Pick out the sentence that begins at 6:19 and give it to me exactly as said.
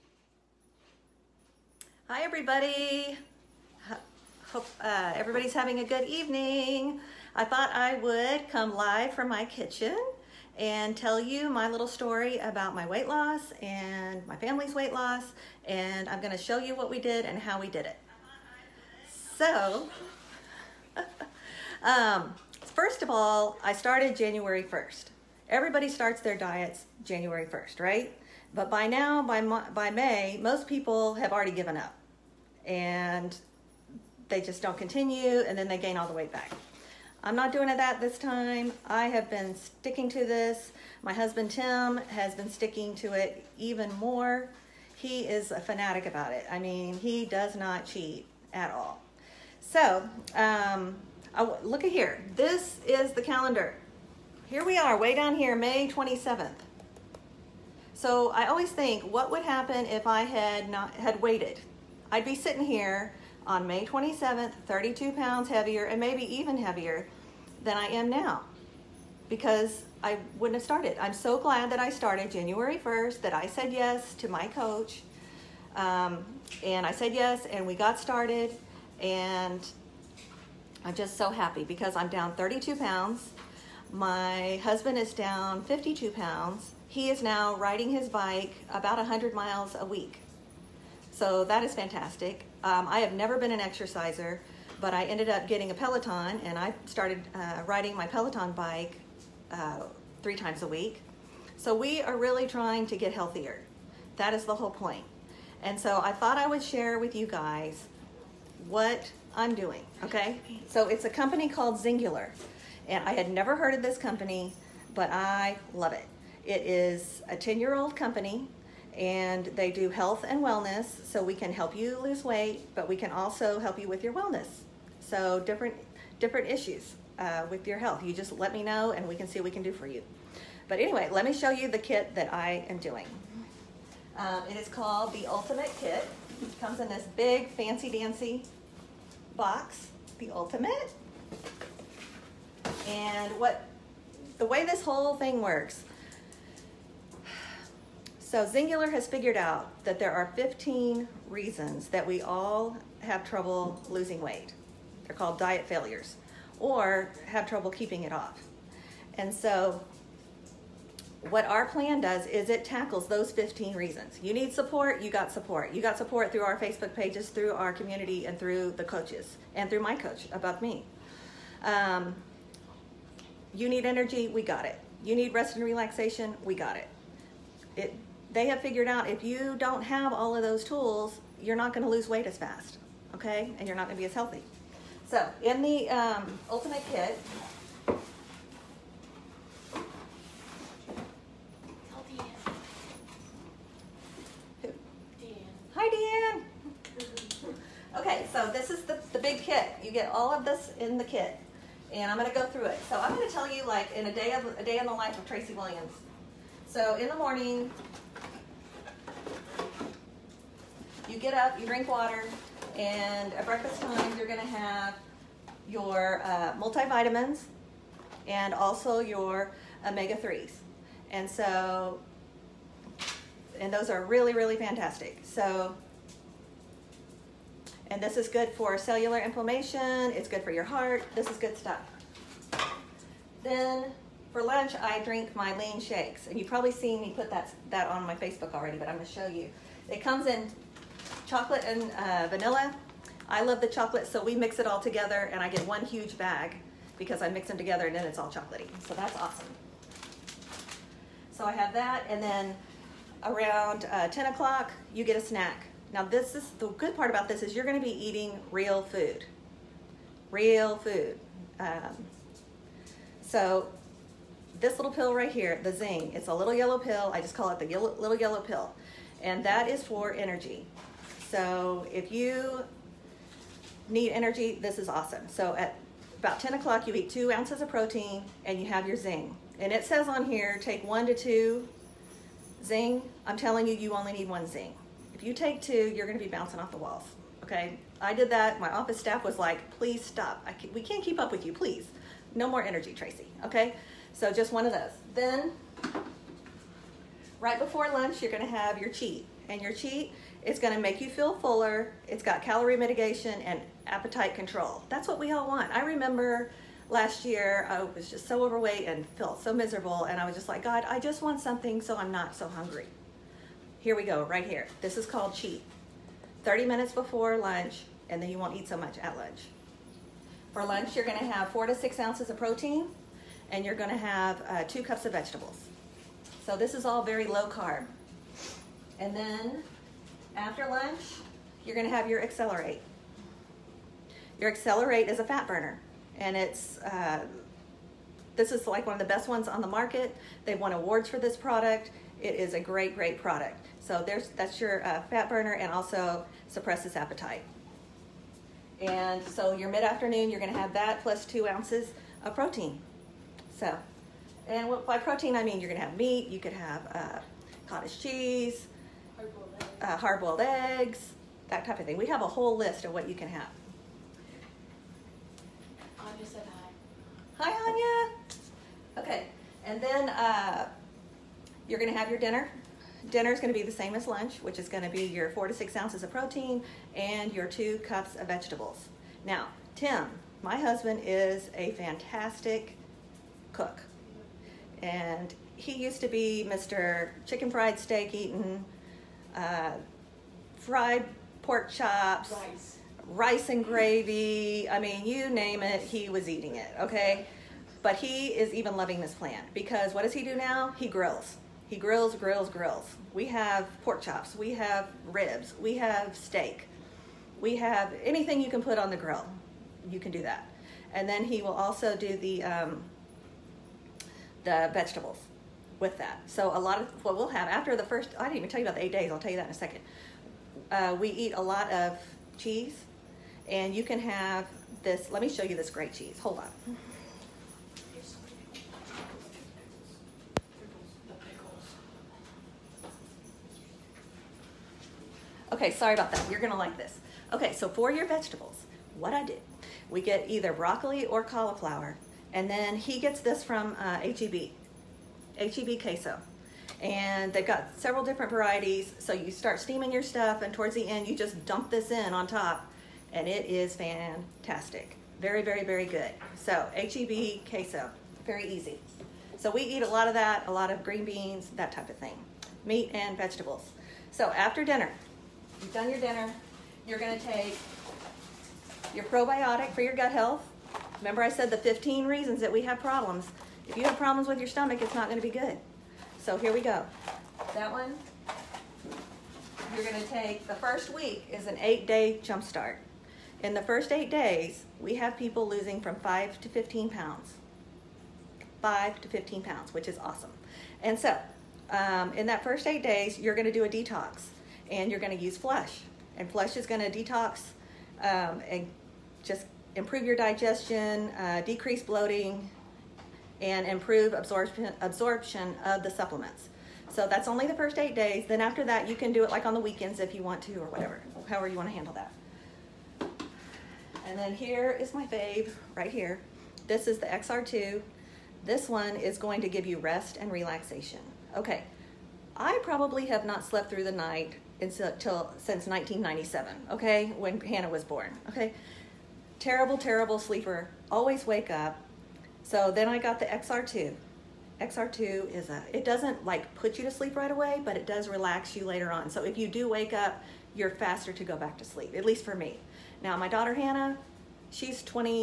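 Now, Tim, my husband is a fantastic cook.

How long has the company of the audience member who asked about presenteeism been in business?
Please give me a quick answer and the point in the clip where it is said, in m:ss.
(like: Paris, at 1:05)
10 years, at 1:57.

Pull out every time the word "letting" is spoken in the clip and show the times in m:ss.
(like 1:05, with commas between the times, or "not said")
not said.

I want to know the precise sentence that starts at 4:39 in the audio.
And it says on here, take one to two Xyng.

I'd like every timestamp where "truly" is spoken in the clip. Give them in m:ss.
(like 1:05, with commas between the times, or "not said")
not said.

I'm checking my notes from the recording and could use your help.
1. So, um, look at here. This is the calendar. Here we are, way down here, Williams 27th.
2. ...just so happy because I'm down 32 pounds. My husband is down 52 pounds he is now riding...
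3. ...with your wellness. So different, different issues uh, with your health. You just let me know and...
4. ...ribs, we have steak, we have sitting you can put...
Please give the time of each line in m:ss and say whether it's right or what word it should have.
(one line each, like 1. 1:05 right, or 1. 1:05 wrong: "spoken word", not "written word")
1. 0:49 wrong: "May", not "Williams"
2. 1:20 right
3. 2:03 right
4. 6:45 wrong: "anything", not "sitting".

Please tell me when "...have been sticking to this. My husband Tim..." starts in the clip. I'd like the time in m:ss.
0:39.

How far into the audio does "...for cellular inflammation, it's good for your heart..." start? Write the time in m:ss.
3:48.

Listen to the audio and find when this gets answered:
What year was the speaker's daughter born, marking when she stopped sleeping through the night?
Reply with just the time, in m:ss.
8:45.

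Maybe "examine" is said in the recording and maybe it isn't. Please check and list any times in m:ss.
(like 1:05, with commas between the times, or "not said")
not said.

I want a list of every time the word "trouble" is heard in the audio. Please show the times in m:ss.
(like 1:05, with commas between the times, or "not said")
2:33, 2:37.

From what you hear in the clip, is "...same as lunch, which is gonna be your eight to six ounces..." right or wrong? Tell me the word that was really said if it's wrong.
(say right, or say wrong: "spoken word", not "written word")
wrong: "four", not "eight".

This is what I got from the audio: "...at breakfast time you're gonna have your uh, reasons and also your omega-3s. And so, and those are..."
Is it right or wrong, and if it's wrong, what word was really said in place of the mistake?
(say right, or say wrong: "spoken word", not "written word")
wrong: "multivitamins", not "reasons".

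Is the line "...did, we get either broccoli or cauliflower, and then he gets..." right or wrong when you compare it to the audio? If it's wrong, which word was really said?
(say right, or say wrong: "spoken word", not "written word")
right.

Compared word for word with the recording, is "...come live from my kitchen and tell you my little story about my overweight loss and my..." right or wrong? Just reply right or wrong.
wrong.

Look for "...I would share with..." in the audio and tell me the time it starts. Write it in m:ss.
1:46.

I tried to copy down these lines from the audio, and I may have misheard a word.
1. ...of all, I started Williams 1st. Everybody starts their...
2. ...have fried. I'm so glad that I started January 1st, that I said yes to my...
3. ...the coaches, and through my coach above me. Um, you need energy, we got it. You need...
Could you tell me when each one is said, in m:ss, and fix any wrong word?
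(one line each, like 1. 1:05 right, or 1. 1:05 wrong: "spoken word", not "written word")
1. 0:23 wrong: "January", not "Williams"
2. 1:10 wrong: "started", not "fried"
3. 2:48 right.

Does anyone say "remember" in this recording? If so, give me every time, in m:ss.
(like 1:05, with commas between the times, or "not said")
5:05, 7:50.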